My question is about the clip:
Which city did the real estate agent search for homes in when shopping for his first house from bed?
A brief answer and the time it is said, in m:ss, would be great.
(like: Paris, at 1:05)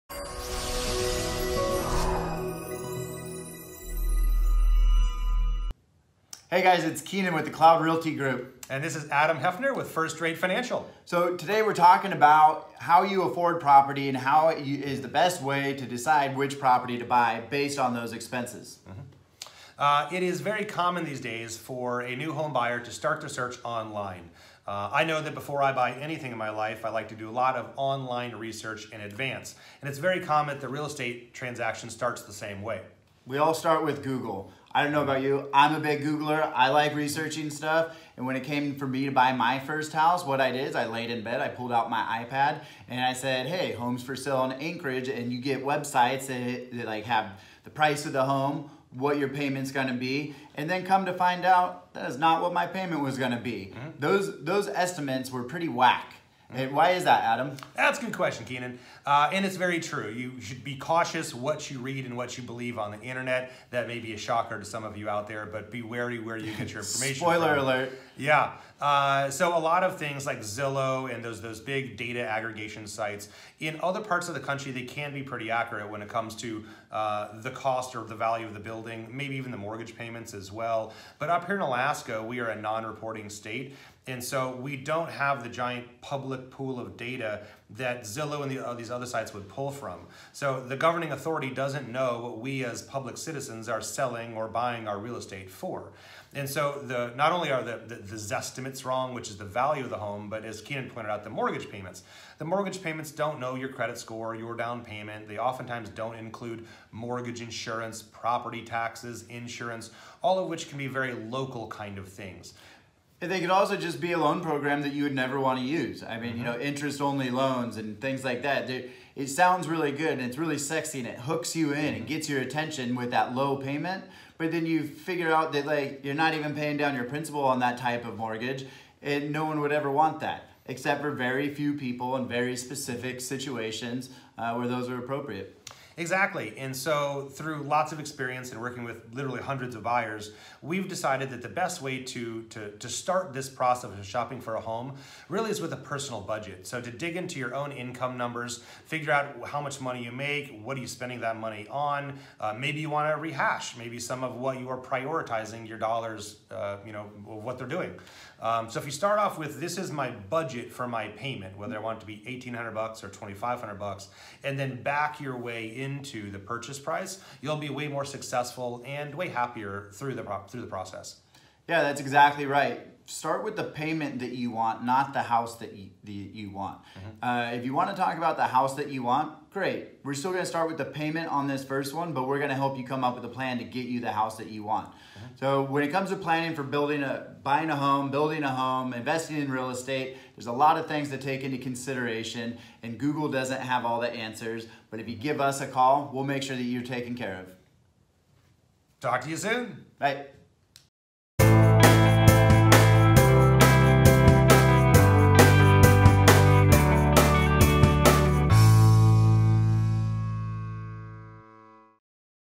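Anchorage, at 0:44.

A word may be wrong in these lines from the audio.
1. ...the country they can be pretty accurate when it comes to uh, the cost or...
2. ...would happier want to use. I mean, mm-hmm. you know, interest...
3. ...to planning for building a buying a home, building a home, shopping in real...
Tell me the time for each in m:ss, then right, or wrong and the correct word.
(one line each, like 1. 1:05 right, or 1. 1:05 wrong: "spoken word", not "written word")
1. 1:14 right
2. 1:55 wrong: "never", not "happier"
3. 3:06 wrong: "investing", not "shopping".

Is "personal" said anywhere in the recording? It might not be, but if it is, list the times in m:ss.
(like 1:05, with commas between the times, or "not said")
2:25.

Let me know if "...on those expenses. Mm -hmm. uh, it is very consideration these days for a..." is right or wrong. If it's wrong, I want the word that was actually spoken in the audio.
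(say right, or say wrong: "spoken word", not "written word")
wrong: "common", not "consideration".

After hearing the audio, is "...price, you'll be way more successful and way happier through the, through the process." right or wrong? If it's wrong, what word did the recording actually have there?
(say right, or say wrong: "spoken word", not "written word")
right.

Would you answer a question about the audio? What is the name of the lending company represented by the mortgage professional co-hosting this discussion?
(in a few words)
First Rate Financial.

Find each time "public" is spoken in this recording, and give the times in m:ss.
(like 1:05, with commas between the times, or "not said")
1:26, 1:32.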